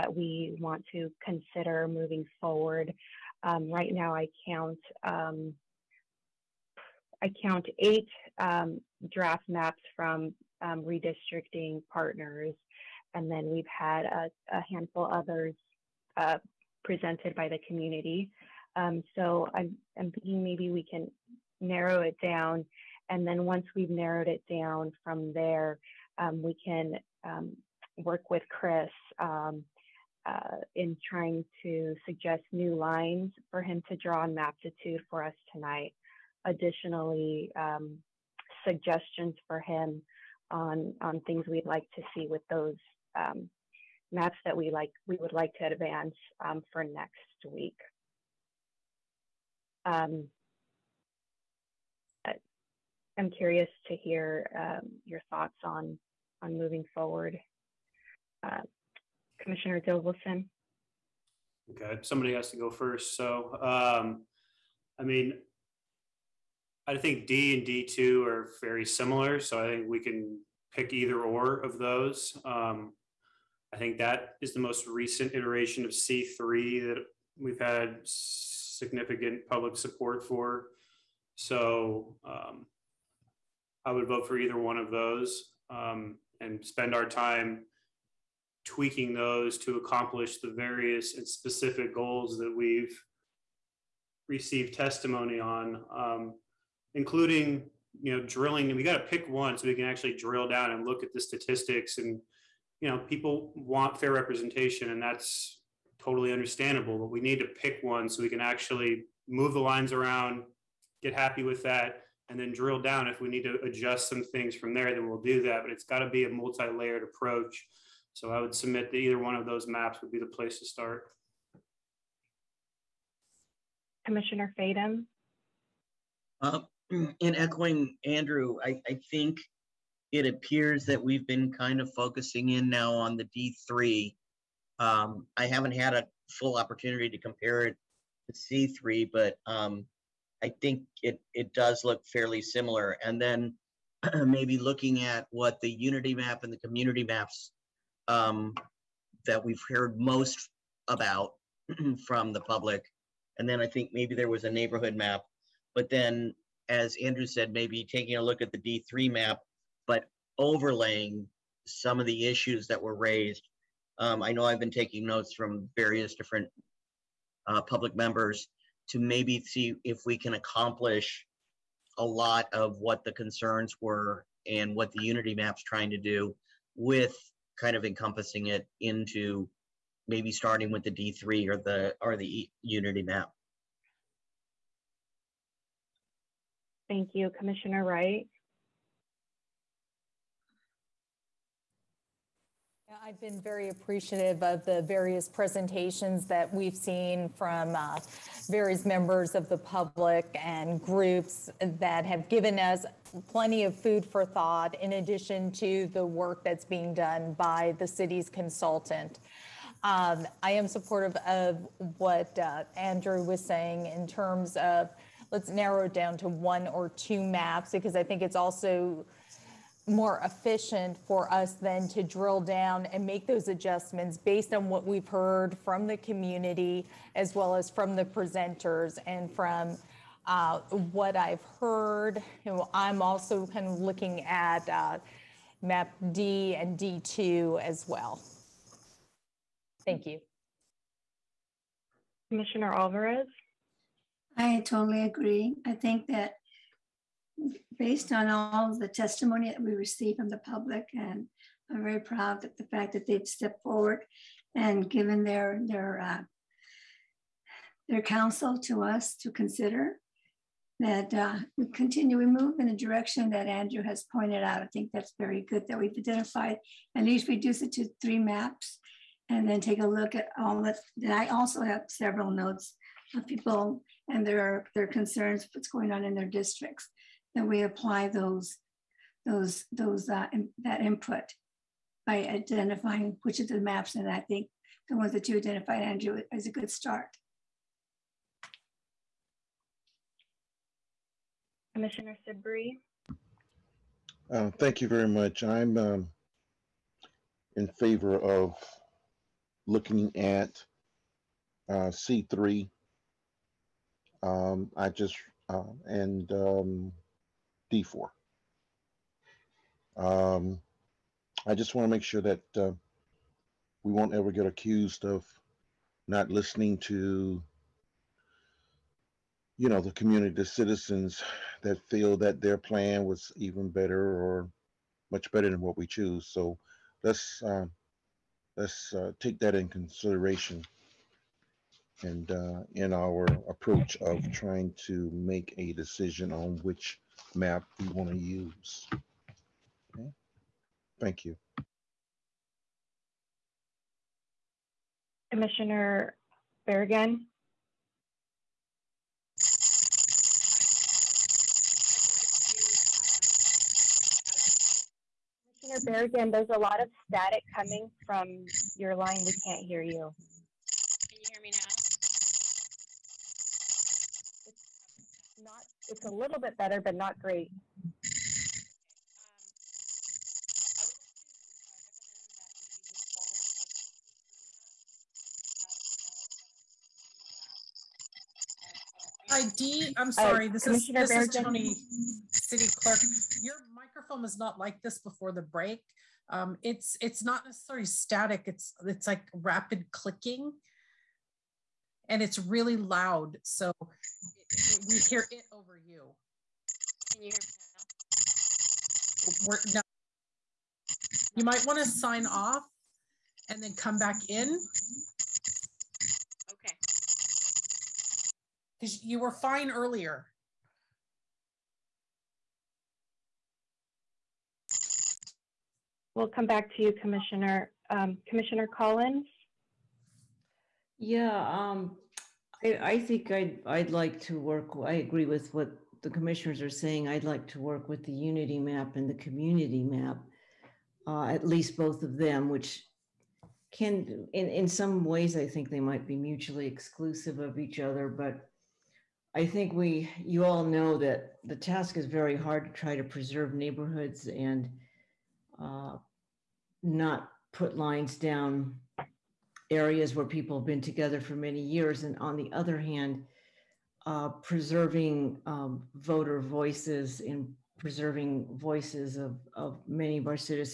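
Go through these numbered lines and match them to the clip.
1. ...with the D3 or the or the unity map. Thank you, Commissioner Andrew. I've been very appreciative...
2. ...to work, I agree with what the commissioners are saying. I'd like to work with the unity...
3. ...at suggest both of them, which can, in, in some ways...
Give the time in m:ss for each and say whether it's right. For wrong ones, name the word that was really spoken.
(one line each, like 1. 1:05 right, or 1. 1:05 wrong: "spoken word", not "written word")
1. 3:00 wrong: "Wright", not "Andrew"
2. 7:04 right
3. 7:11 wrong: "least", not "suggest".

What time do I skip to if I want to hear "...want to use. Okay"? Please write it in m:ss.
5:37.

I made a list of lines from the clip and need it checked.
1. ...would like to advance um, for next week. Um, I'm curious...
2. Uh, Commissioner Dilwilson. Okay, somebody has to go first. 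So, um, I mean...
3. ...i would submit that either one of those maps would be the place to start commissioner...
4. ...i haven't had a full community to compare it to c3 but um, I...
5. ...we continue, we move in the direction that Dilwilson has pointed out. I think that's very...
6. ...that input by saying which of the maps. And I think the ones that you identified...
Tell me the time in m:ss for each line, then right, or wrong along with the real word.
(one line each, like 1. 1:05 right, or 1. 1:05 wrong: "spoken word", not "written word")
1. 0:45 right
2. 0:58 right
3. 1:58 right
4. 2:15 wrong: "opportunity", not "community"
5. 4:21 wrong: "Andrew", not "Dilwilson"
6. 4:40 wrong: "identifying", not "saying".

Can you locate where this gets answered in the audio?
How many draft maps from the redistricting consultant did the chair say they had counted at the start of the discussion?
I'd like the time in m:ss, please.
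0:07.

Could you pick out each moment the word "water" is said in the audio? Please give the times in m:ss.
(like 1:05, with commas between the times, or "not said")
not said.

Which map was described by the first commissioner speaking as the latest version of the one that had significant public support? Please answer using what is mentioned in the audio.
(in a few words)
C3.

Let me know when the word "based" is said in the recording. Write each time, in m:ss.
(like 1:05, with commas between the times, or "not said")
3:44, 4:07.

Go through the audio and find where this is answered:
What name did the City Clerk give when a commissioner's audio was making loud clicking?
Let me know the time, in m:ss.
6:21.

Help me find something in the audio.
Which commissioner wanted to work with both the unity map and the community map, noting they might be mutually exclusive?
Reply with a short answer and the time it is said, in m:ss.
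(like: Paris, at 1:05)
Commissioner Collins, at 6:58.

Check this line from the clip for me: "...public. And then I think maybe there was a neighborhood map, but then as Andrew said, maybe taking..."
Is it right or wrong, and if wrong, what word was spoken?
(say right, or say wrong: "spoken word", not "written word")
right.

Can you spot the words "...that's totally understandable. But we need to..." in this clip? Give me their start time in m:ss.
1:45.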